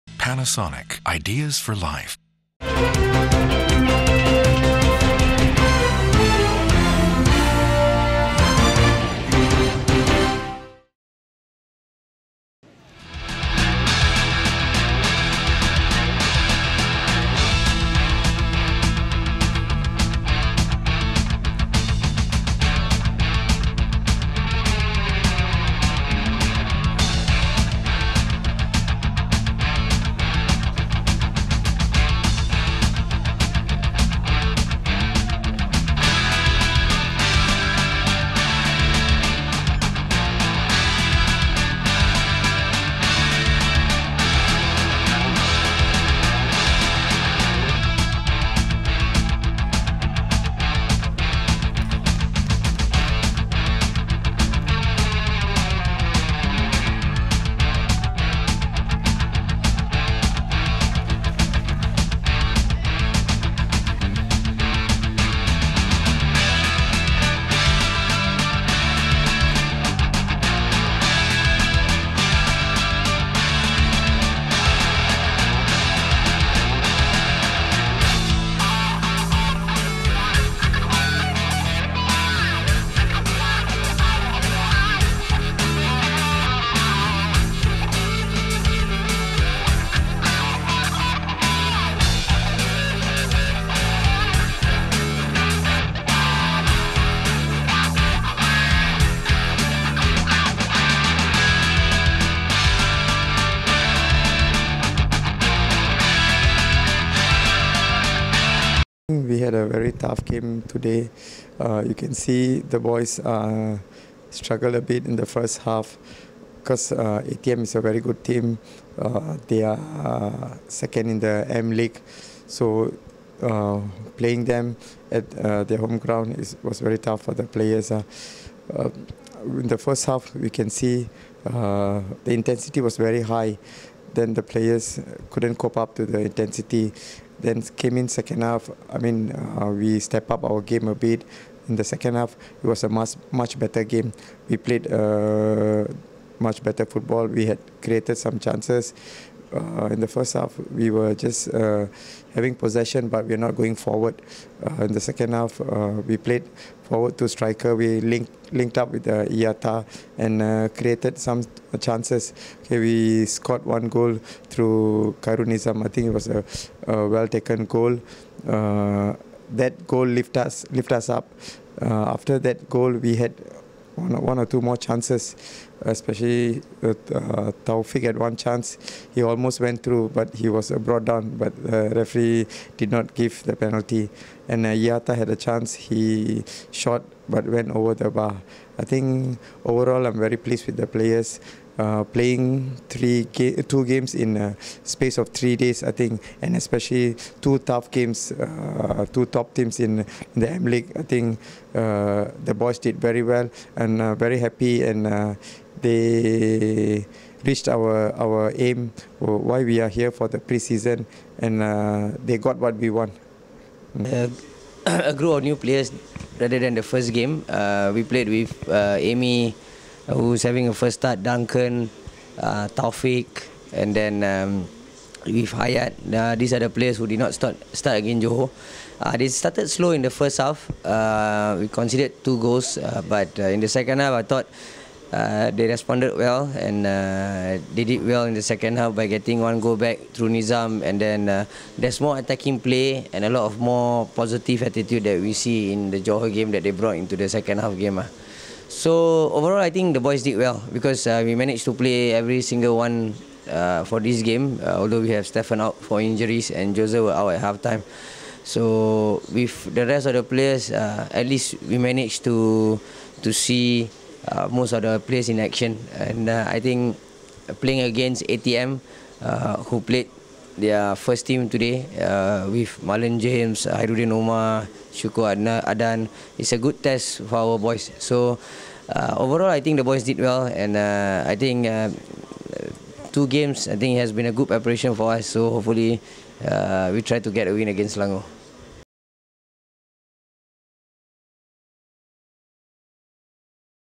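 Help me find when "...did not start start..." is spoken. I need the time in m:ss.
3:47.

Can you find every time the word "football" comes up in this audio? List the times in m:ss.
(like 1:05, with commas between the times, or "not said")
2:26.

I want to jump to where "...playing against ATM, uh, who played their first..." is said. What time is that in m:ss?
4:27.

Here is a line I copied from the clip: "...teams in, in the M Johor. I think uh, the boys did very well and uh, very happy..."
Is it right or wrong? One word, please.
wrong.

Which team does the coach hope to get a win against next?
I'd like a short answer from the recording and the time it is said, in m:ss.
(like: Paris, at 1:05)
Selangor, at 4:47.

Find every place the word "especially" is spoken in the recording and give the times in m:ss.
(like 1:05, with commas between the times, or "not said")
2:55, 3:16.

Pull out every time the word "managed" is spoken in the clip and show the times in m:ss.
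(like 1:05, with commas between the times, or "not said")
4:11, 4:21.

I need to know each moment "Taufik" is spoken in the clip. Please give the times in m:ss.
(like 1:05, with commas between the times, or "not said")
2:57, 3:42.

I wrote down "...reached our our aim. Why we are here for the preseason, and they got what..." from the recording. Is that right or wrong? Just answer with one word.
right.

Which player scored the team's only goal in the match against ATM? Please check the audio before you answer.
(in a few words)
Khairul Nizam.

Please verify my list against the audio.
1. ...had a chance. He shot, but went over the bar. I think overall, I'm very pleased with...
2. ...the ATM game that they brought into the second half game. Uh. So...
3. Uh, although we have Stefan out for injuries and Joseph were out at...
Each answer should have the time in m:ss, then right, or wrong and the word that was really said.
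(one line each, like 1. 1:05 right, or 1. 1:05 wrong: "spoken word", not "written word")
1. 3:05 right
2. 4:05 wrong: "Johor", not "ATM"
3. 4:14 right.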